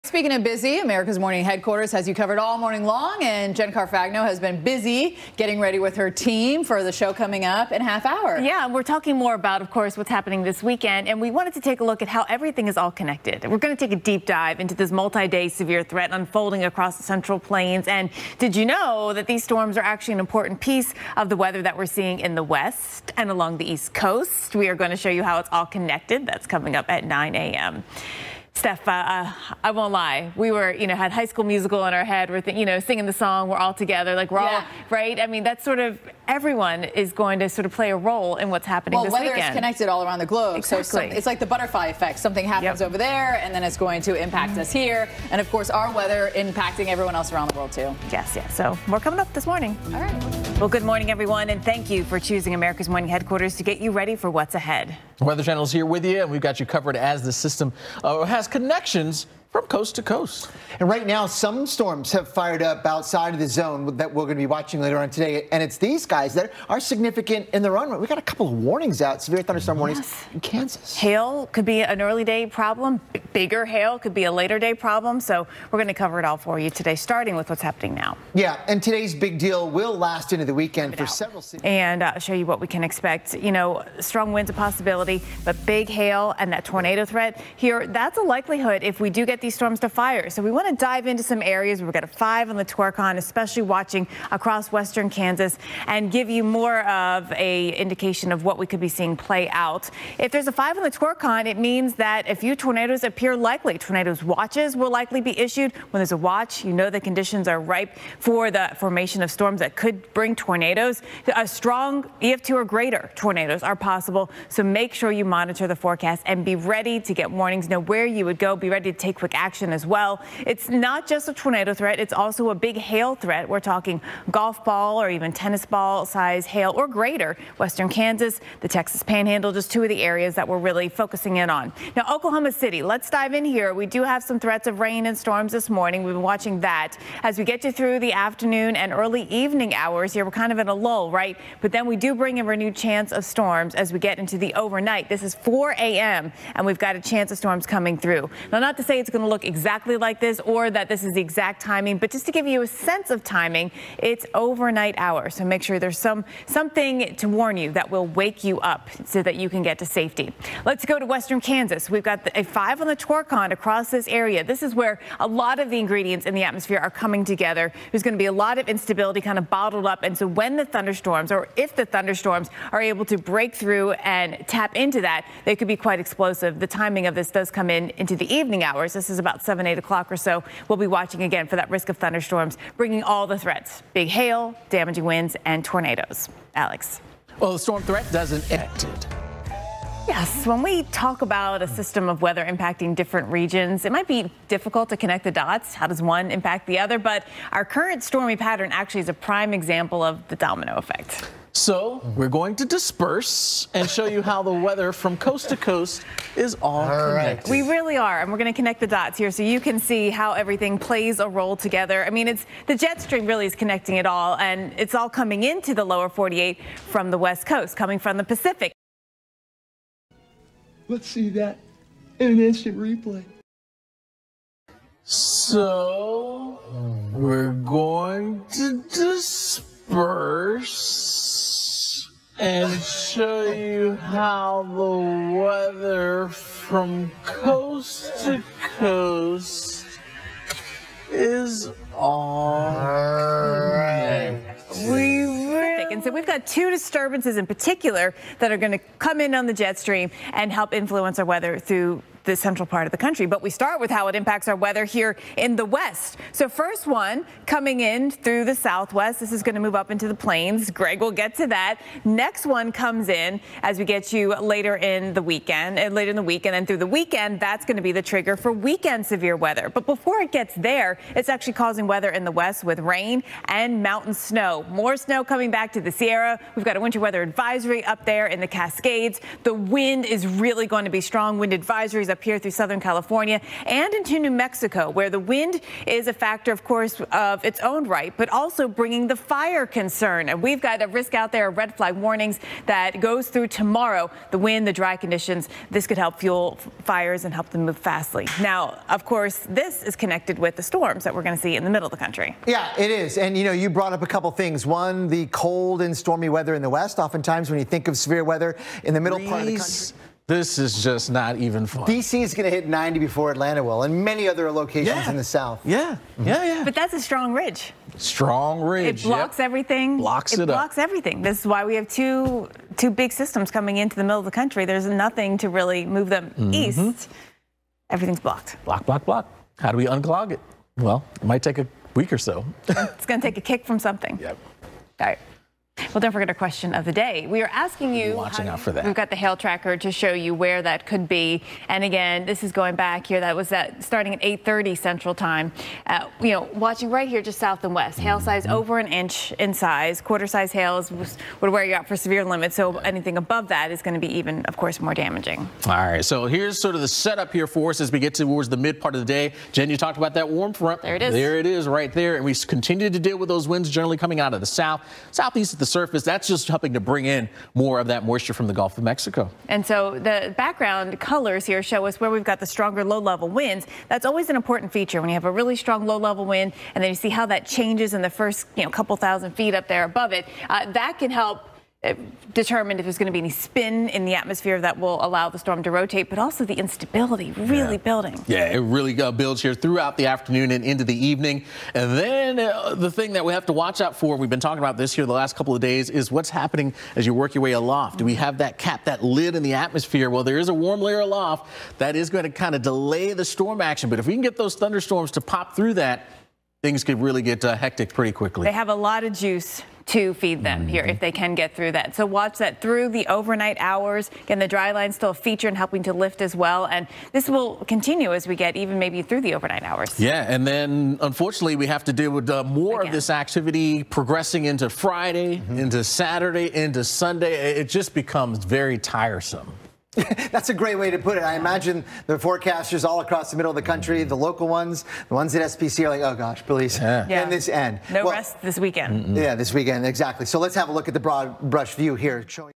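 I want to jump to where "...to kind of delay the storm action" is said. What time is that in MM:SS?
06:42.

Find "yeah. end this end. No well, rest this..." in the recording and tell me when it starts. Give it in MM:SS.
07:17.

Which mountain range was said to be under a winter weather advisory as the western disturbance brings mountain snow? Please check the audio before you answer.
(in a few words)
Cascades.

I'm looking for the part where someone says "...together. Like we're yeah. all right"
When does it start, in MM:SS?
00:33.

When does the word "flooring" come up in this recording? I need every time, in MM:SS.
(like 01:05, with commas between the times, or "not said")
not said.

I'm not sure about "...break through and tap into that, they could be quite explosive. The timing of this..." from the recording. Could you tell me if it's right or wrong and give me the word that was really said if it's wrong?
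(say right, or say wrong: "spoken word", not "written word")
right.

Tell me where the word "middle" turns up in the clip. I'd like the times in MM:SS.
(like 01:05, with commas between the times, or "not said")
05:01, 05:08, 05:24, 07:13.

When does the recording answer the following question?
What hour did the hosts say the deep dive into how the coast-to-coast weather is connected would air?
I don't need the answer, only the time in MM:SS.
00:27.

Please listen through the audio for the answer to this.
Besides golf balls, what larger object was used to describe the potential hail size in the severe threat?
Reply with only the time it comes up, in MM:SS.
02:05.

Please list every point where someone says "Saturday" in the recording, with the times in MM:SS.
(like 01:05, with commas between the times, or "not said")
07:05.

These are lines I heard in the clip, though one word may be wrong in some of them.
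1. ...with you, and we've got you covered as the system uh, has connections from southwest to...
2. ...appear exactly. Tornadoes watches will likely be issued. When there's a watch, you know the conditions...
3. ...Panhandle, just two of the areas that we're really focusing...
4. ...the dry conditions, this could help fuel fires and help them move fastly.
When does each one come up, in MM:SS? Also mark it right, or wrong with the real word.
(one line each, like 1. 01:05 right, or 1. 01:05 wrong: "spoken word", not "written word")
1. 00:55 wrong: "coast", not "southwest"
2. 01:43 wrong: "likely", not "exactly"
3. 02:09 right
4. 04:54 right.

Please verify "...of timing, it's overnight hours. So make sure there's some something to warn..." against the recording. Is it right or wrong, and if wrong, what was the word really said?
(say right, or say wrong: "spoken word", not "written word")
right.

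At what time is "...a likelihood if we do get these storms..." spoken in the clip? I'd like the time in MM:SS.
01:28.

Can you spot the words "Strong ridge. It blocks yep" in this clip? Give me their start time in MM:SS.
05:17.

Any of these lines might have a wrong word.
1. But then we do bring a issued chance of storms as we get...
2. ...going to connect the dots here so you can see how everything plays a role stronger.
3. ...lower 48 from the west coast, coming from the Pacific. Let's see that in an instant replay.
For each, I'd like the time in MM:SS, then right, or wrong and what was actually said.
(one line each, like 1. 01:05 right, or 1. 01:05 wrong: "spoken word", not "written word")
1. 02:21 wrong: "renewed", not "issued"
2. 03:28 wrong: "together", not "stronger"
3. 03:35 right.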